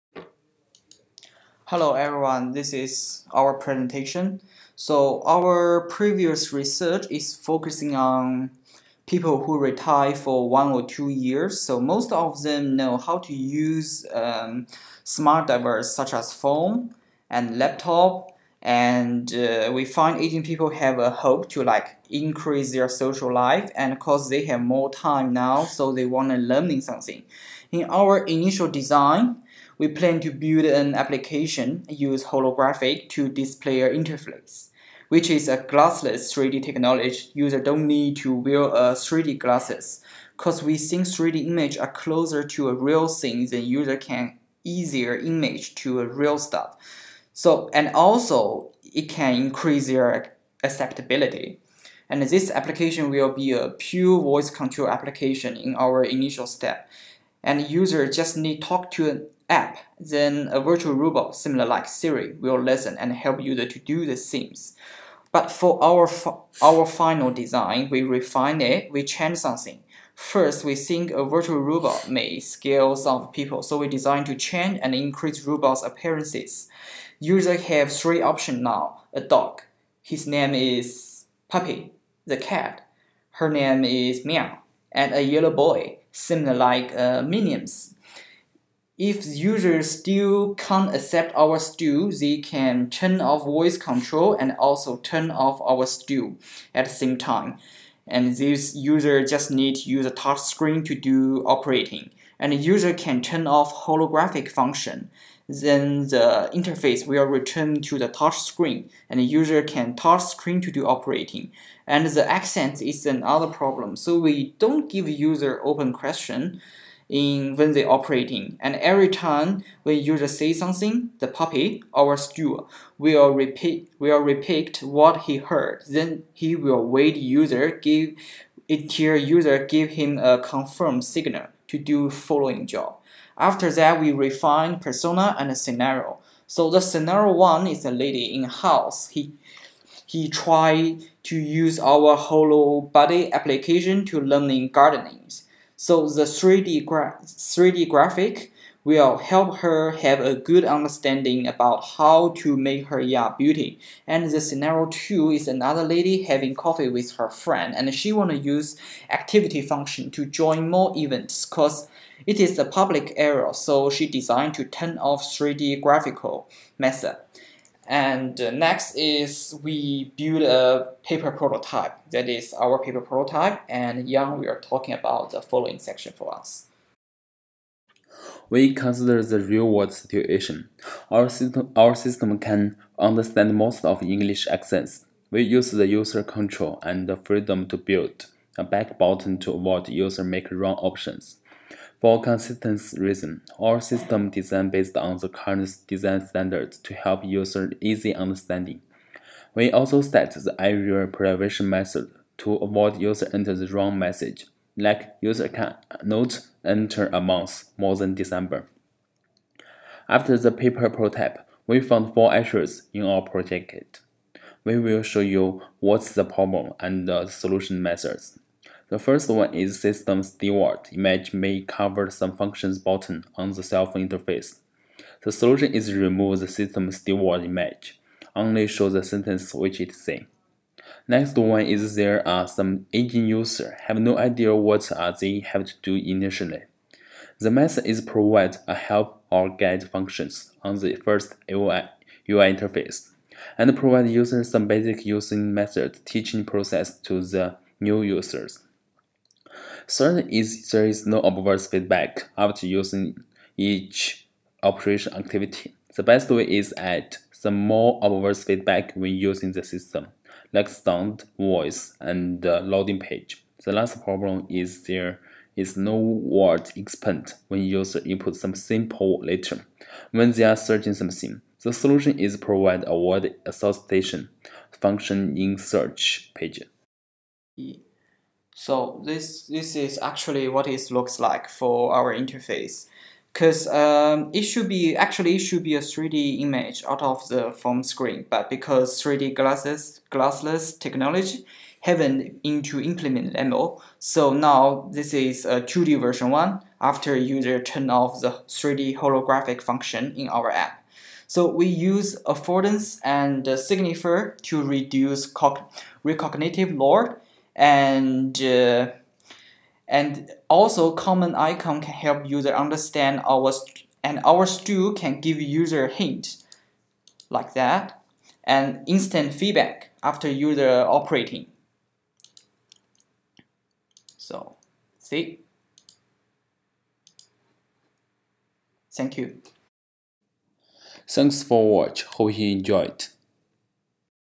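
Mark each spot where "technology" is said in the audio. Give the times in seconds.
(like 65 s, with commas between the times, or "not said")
36 s, 290 s.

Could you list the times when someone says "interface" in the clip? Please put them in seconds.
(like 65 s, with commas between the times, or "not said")
33 s, 106 s, 224 s, 242 s, 282 s.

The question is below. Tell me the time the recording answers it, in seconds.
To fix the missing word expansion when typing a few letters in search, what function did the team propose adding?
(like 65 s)
272 s.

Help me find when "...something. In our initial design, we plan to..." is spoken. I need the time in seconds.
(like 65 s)
26 s.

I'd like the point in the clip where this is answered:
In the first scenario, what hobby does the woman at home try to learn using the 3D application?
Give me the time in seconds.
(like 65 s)
144 s.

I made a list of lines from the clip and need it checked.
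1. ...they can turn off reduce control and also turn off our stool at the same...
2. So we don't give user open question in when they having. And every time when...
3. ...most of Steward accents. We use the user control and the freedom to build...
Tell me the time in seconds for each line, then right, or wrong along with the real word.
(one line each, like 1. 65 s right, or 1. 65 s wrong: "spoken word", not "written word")
1. 92 s wrong: "voice", not "reduce"
2. 113 s wrong: "operating", not "having"
3. 183 s wrong: "English", not "Steward".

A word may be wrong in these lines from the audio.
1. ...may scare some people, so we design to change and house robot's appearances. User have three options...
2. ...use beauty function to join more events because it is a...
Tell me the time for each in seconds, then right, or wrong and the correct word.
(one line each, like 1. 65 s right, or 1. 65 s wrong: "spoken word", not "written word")
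1. 72 s wrong: "increase", not "house"
2. 158 s wrong: "activity", not "beauty".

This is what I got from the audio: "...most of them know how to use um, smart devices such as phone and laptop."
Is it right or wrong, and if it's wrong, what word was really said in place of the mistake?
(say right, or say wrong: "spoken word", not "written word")
right.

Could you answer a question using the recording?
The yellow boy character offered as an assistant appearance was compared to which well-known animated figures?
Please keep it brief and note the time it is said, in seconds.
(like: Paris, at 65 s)
Minions, at 87 s.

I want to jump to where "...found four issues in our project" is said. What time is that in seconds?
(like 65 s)
211 s.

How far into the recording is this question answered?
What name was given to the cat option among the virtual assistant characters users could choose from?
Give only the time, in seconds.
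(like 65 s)
84 s.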